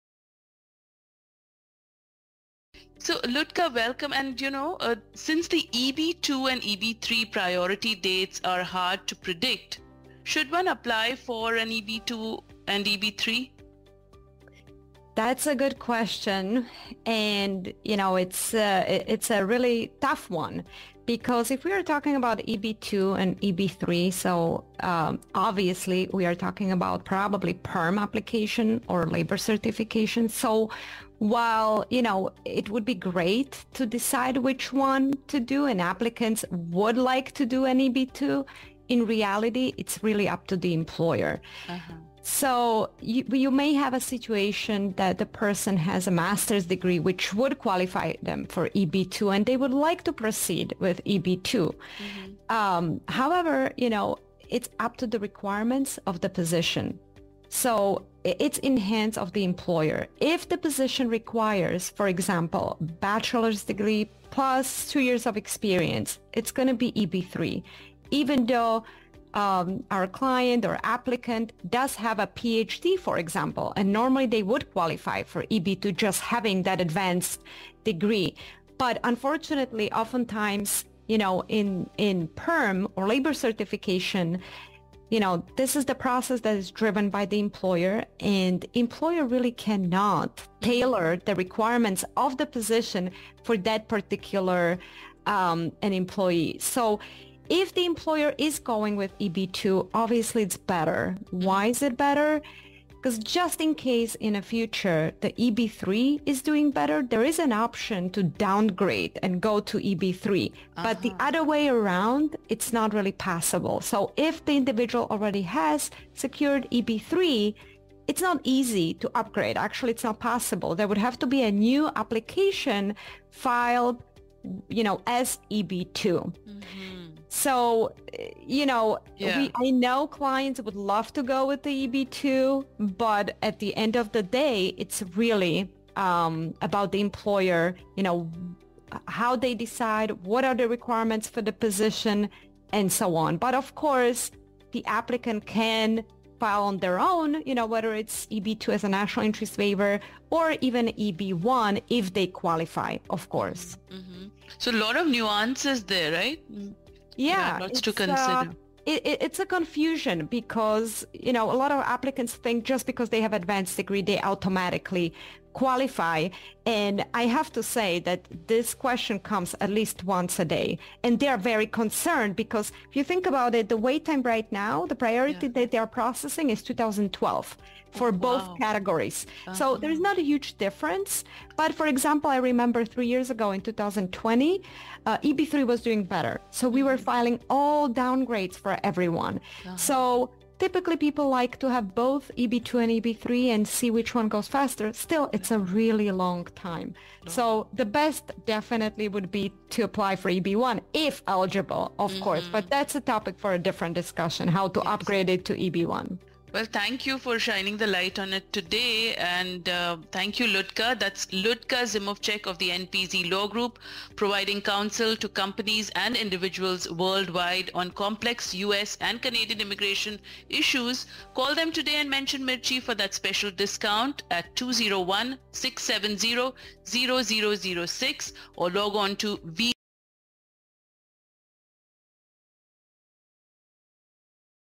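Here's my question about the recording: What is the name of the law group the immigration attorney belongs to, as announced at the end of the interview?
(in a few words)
NPZ Law Group.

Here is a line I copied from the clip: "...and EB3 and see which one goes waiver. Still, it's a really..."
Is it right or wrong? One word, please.
wrong.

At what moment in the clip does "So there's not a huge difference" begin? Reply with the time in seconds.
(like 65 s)
179 s.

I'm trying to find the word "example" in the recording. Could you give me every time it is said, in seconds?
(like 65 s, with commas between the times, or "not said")
62 s, 73 s, 181 s.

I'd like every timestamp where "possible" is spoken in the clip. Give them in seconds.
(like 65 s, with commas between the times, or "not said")
113 s, 120 s.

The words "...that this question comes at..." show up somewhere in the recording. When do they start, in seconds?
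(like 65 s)
167 s.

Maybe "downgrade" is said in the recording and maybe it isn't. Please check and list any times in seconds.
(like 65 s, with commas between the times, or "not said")
108 s, 187 s.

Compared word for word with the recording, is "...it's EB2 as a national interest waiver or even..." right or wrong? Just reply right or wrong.
right.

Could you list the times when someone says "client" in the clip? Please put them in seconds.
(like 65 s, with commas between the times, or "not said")
70 s, 130 s.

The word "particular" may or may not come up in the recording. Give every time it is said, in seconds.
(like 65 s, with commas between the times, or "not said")
93 s.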